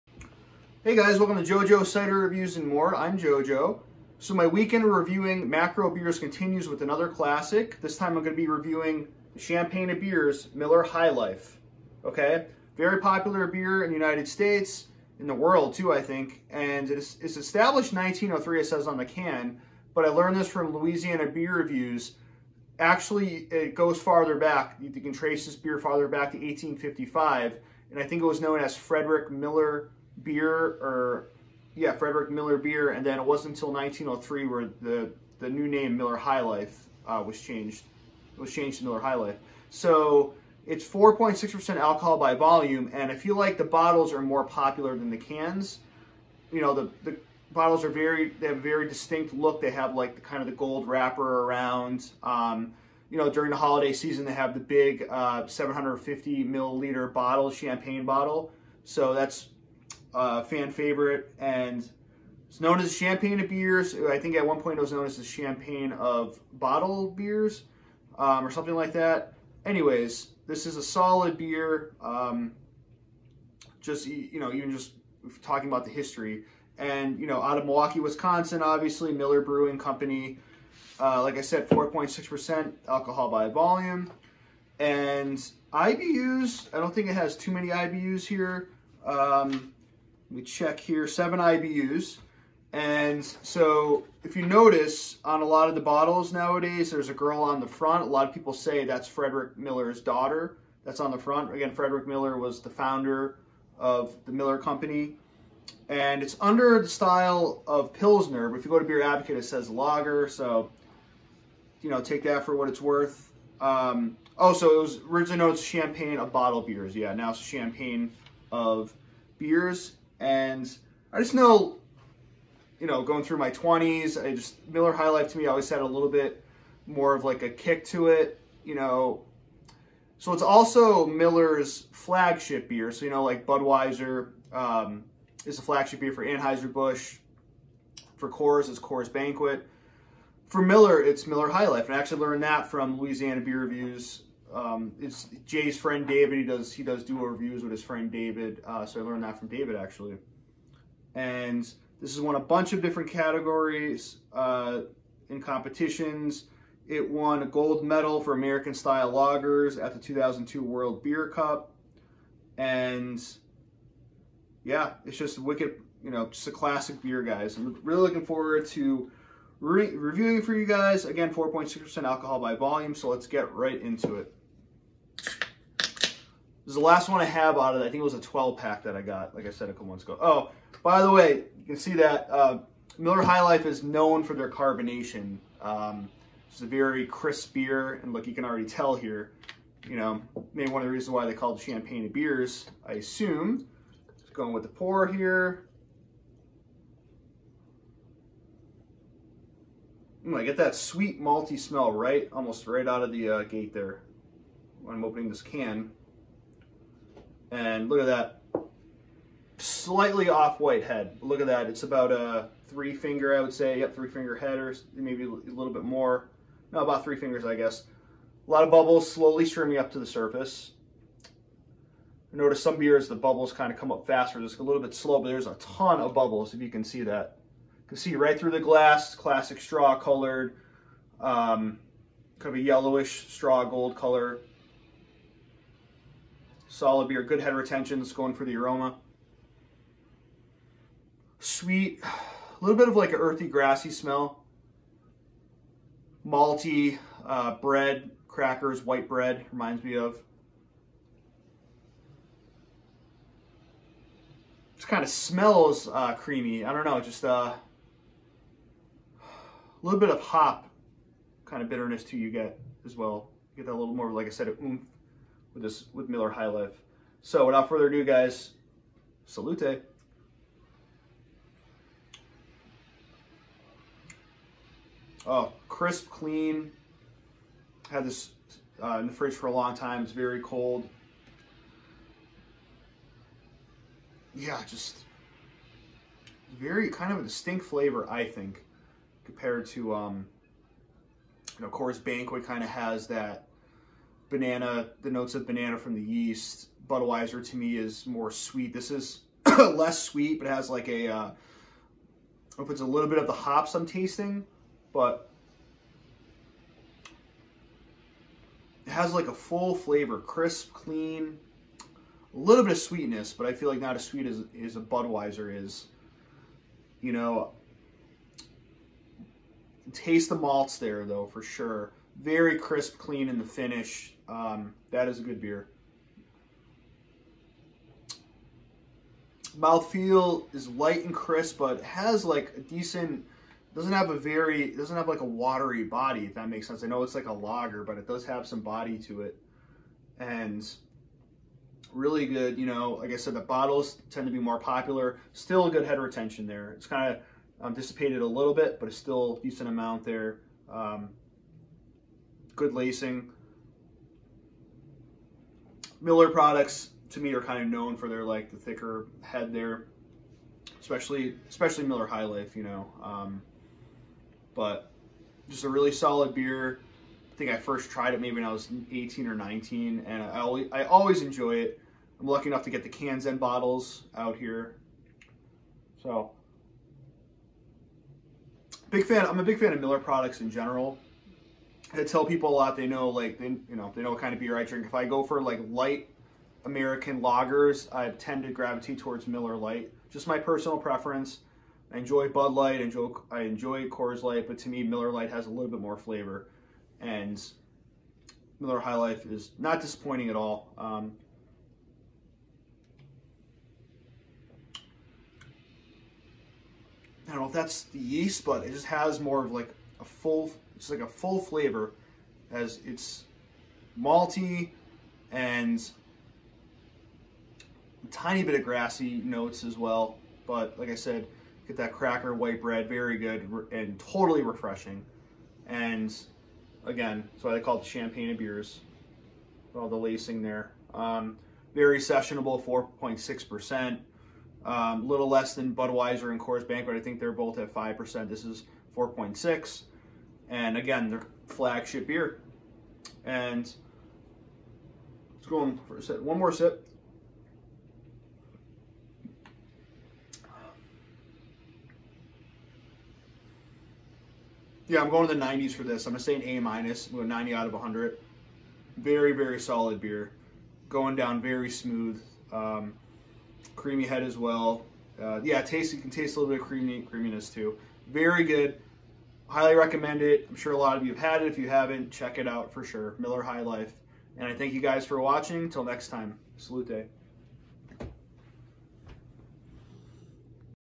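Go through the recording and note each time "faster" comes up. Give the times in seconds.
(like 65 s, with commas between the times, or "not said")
224 s.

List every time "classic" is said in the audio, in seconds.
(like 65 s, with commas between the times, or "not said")
7 s, 166 s, 229 s.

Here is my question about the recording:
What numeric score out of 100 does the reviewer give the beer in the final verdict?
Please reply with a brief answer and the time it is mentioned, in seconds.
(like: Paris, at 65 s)
90, at 457 s.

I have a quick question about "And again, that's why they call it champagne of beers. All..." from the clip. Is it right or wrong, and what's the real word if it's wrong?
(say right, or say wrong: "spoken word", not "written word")
right.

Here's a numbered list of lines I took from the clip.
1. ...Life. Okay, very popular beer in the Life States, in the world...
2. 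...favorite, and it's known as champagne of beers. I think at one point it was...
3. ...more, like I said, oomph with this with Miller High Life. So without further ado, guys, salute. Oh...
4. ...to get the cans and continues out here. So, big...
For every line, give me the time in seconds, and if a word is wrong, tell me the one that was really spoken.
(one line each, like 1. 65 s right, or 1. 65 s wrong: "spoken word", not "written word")
1. 11 s wrong: "United", not "Life"
2. 60 s right
3. 263 s right
4. 372 s wrong: "bottles", not "continues".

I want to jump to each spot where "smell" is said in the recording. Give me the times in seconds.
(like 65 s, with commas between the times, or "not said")
201 s, 243 s, 255 s.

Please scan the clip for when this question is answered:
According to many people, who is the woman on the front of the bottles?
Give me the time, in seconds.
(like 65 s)
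99 s.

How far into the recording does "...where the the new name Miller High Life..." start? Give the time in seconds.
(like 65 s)
34 s.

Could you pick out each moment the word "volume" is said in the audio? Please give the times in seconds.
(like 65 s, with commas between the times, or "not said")
42 s, 83 s, 172 s.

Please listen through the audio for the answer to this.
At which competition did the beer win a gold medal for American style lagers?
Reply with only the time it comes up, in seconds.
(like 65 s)
159 s.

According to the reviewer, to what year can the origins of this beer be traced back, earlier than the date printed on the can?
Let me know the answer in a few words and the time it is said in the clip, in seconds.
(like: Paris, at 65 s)
1855, at 26 s.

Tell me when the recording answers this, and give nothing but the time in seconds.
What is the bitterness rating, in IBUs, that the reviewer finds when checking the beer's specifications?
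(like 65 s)
91 s.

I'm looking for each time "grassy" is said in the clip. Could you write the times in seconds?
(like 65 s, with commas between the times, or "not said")
243 s, 418 s.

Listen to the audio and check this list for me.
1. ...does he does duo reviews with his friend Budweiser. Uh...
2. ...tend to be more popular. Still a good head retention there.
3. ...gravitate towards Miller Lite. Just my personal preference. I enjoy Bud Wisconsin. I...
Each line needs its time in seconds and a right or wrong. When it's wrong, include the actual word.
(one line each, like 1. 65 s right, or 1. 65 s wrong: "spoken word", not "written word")
1. 146 s wrong: "David", not "Budweiser"
2. 344 s right
3. 388 s wrong: "Light", not "Wisconsin".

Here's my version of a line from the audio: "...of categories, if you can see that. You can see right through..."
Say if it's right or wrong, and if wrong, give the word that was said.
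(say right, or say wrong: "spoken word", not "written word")
wrong: "bubbles", not "categories".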